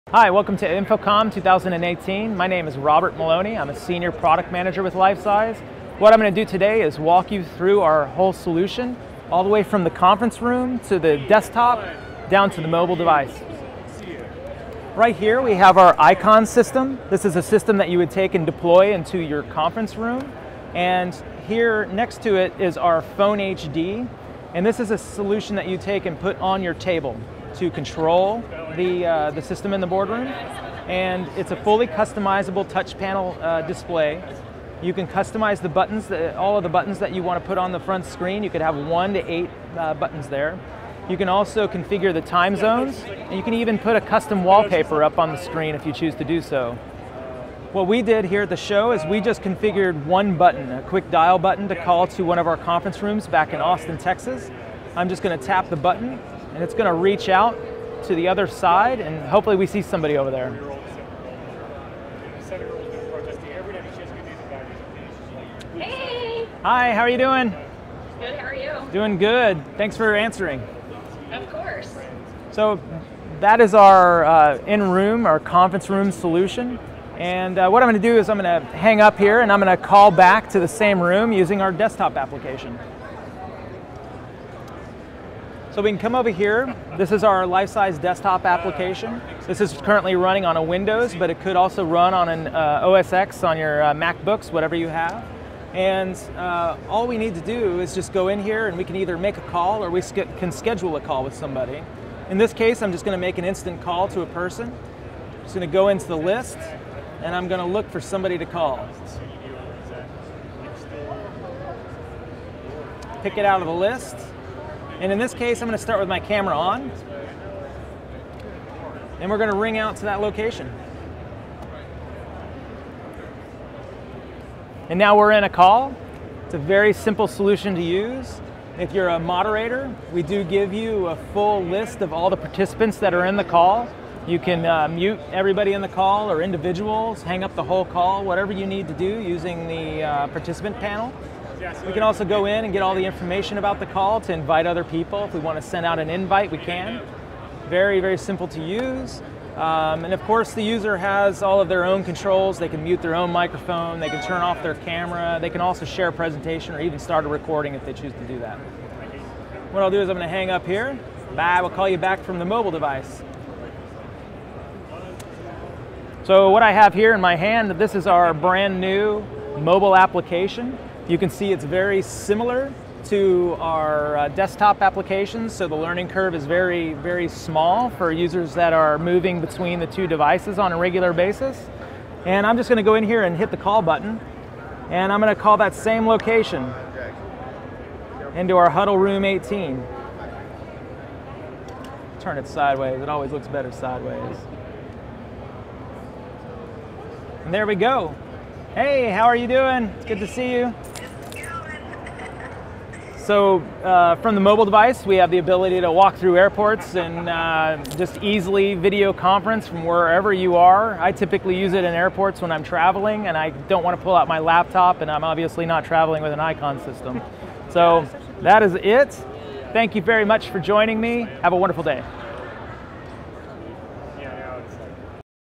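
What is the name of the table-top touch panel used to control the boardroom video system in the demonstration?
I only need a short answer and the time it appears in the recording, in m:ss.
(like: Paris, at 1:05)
Phone HD, at 0:23.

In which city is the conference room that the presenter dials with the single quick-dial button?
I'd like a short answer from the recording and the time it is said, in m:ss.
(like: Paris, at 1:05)
Austin, Texas, at 0:53.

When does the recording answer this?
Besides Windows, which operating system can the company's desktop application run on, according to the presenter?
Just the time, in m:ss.
1:32.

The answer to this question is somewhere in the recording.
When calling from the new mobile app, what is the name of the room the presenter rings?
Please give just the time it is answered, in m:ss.
3:08.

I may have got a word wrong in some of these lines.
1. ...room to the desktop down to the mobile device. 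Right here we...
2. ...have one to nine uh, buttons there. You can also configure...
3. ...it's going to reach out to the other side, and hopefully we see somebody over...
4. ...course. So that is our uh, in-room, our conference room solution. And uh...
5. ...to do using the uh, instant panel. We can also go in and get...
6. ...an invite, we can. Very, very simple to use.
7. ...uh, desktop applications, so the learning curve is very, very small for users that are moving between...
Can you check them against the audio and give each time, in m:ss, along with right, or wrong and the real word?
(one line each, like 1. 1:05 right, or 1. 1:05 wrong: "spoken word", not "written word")
1. 0:10 right
2. 0:38 wrong: "eight", not "nine"
3. 0:56 right
4. 1:11 right
5. 2:18 wrong: "participant", not "instant"
6. 2:25 right
7. 2:54 right.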